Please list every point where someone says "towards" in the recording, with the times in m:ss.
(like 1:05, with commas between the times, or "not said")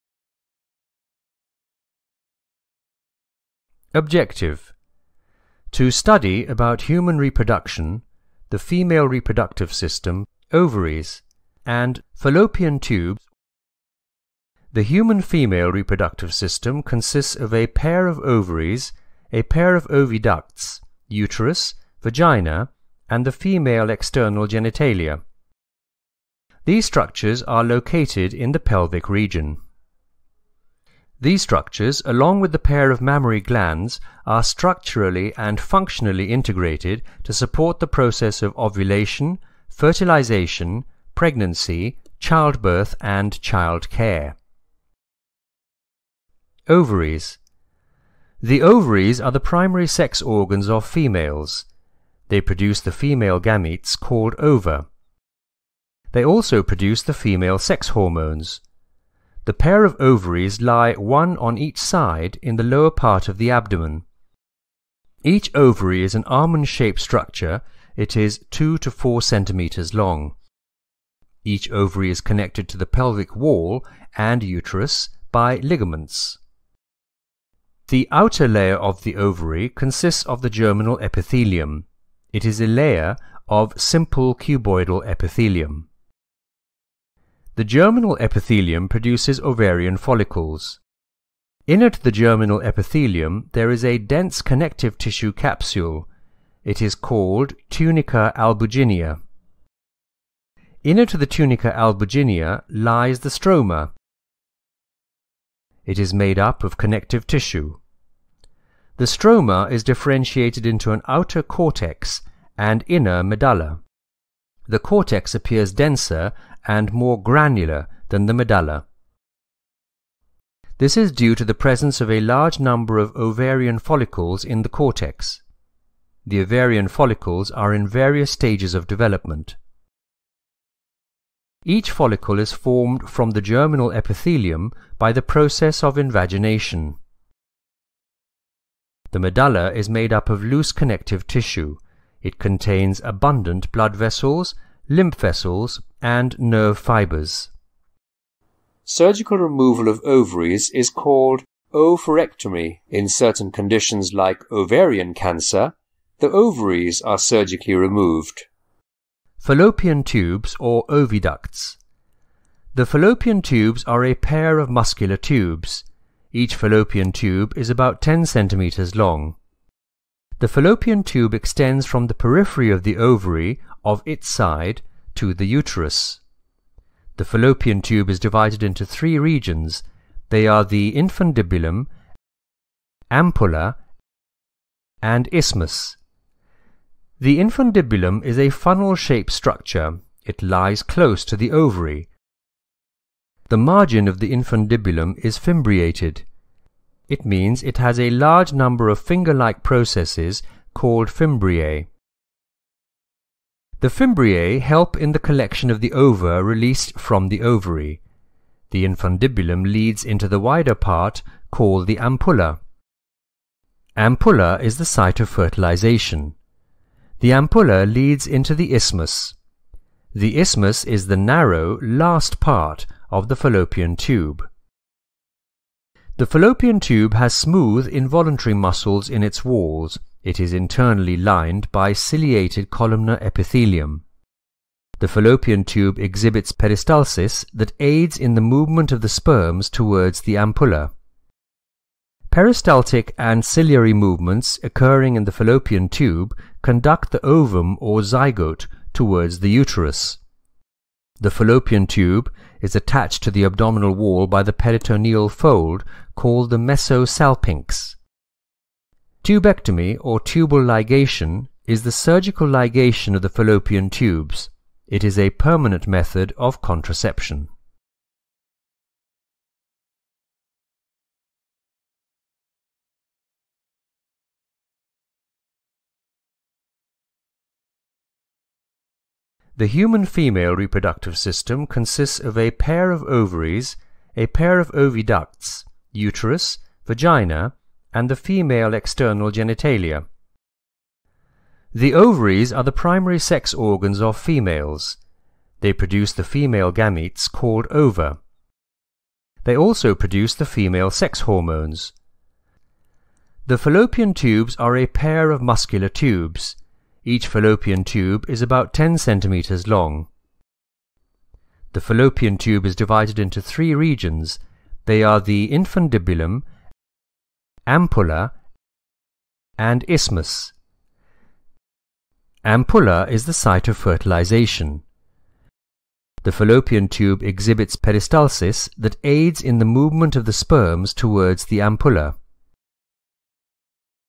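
3:59, 4:08, 5:30.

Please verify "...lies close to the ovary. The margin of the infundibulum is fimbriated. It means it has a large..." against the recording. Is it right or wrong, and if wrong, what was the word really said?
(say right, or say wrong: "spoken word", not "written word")
right.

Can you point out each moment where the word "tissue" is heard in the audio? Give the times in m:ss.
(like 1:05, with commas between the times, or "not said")
1:34, 1:47, 2:21.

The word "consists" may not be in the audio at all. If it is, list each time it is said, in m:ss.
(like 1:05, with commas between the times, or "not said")
0:16, 1:19, 4:41.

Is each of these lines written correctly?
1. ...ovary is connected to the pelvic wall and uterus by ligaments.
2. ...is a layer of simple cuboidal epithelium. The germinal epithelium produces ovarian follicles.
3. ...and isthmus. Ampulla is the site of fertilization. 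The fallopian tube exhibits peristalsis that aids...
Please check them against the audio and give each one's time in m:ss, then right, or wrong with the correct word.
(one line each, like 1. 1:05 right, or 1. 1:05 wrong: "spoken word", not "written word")
1. 1:11 right
2. 1:22 right
3. 5:19 right.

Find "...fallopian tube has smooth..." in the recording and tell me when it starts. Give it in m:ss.
3:46.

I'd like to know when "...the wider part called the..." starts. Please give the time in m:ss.
3:30.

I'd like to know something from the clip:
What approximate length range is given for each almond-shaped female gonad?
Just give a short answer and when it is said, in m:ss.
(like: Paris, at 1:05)
2 to 4 centimeters, at 1:08.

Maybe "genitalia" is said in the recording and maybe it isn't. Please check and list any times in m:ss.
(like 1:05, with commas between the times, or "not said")
0:24, 4:49.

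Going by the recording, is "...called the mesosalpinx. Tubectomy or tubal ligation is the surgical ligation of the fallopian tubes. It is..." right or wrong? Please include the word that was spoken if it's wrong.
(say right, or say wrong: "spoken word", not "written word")
right.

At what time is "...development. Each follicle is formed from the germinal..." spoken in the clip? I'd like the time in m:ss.
2:08.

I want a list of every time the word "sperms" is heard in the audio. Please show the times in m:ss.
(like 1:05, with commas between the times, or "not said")
3:59, 5:30.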